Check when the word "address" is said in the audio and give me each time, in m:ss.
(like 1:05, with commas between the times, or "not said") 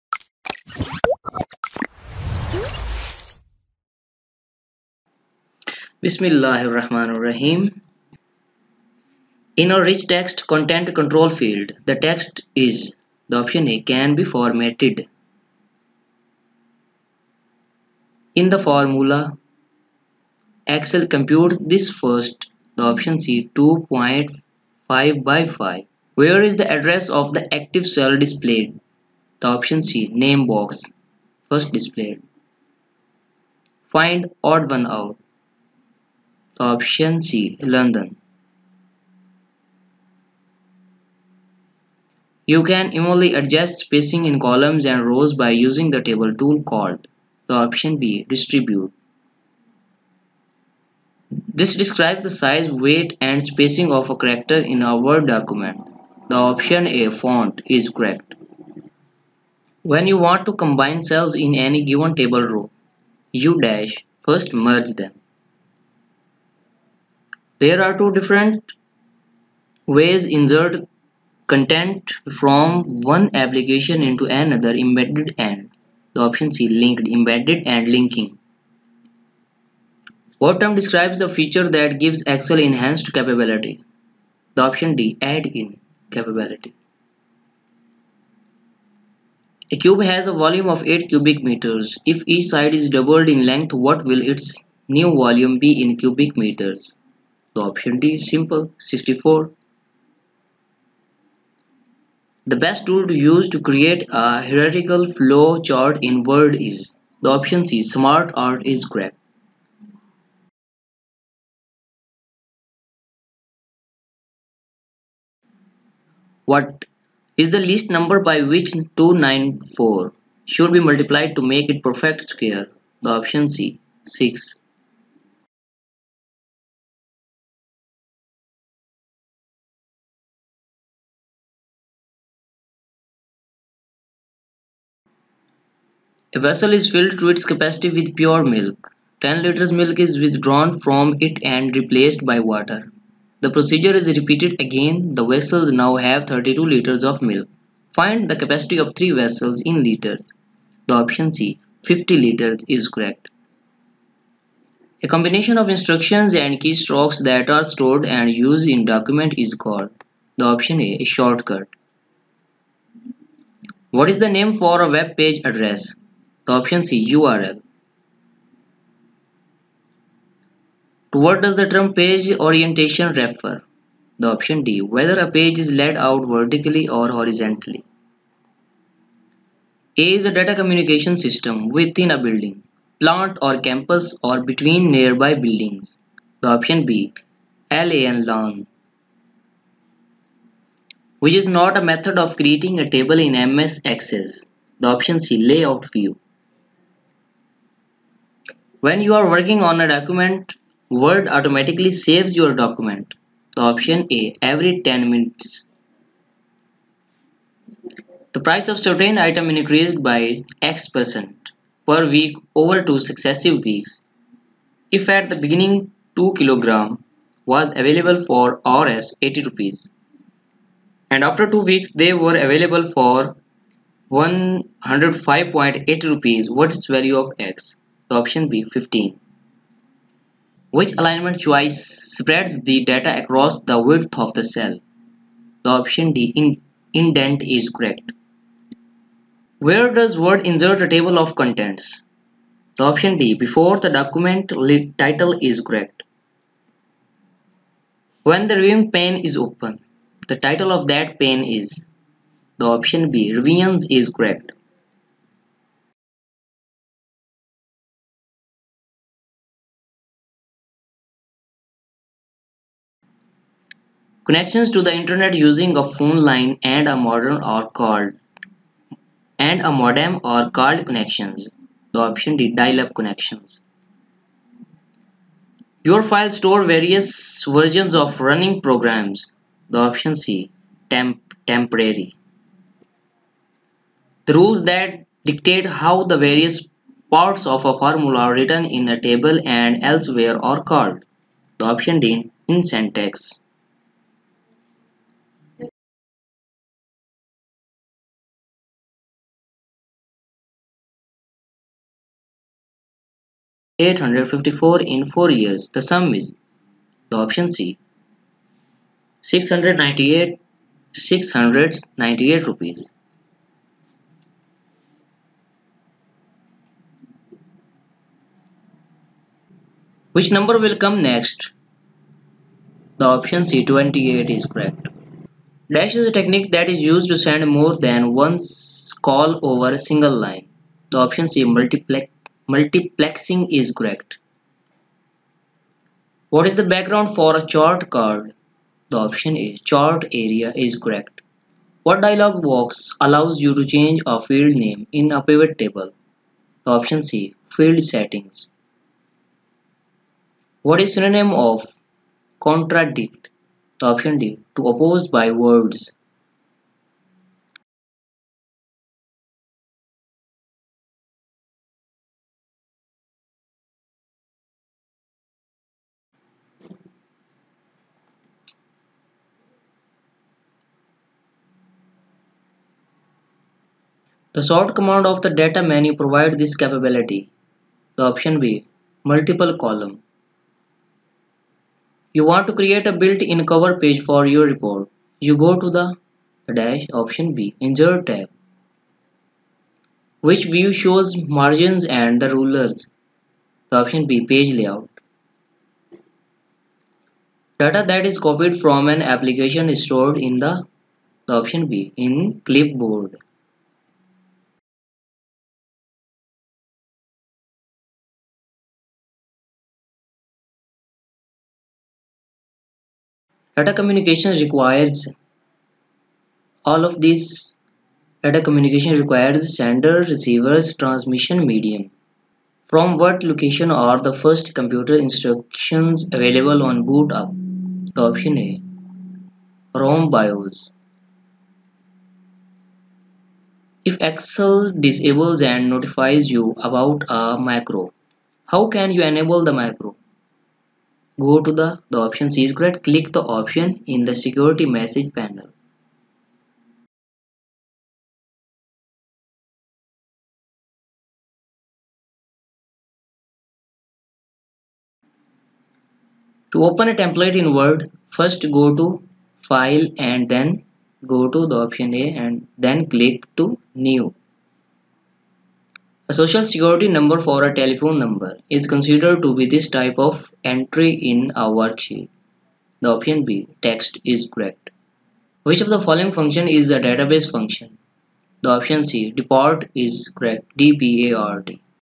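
0:26, 2:45.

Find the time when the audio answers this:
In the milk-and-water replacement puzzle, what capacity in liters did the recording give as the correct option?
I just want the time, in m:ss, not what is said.
2:31.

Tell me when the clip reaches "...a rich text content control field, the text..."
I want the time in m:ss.
0:09.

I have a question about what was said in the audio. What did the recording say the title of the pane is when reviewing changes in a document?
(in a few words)
revisions.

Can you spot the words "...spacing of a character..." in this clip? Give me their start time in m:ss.
0:53.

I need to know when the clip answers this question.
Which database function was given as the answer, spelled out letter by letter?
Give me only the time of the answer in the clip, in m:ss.
8:00.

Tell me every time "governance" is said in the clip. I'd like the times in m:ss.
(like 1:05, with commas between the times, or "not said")
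not said.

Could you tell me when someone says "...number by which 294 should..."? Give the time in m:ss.
1:57.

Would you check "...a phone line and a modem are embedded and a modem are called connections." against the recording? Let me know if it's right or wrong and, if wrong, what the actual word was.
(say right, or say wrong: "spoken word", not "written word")
wrong: "called", not "embedded".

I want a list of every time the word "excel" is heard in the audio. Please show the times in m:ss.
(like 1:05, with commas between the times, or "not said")
0:20, 1:22, 7:14.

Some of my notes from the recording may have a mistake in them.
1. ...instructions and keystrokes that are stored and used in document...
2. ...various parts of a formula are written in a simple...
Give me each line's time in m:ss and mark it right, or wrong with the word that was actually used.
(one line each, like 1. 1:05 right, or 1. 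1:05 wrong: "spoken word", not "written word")
1. 2:35 right
2. 4:46 wrong: "table", not "simple".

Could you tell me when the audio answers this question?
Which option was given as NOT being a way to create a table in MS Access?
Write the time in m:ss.
3:15.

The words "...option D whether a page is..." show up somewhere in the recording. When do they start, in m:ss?
2:54.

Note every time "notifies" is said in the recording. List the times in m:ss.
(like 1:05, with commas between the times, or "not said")
7:15.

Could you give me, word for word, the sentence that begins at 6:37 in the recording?
Data that is copied from an application is stored in the, the option B, in clipboard.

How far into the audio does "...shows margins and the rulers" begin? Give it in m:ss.
6:30.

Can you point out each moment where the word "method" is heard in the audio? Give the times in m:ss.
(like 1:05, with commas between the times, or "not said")
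3:11.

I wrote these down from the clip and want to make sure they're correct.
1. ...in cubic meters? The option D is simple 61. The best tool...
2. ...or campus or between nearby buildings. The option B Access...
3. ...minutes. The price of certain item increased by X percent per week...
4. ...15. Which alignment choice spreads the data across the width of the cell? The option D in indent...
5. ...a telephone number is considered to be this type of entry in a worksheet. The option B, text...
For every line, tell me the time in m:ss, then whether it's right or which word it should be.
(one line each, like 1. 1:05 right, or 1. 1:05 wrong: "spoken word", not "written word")
1. 1:35 wrong: "64", not "61"
2. 3:03 wrong: "LAN", not "Access"
3. 3:25 right
4. 3:48 right
5. 7:47 right.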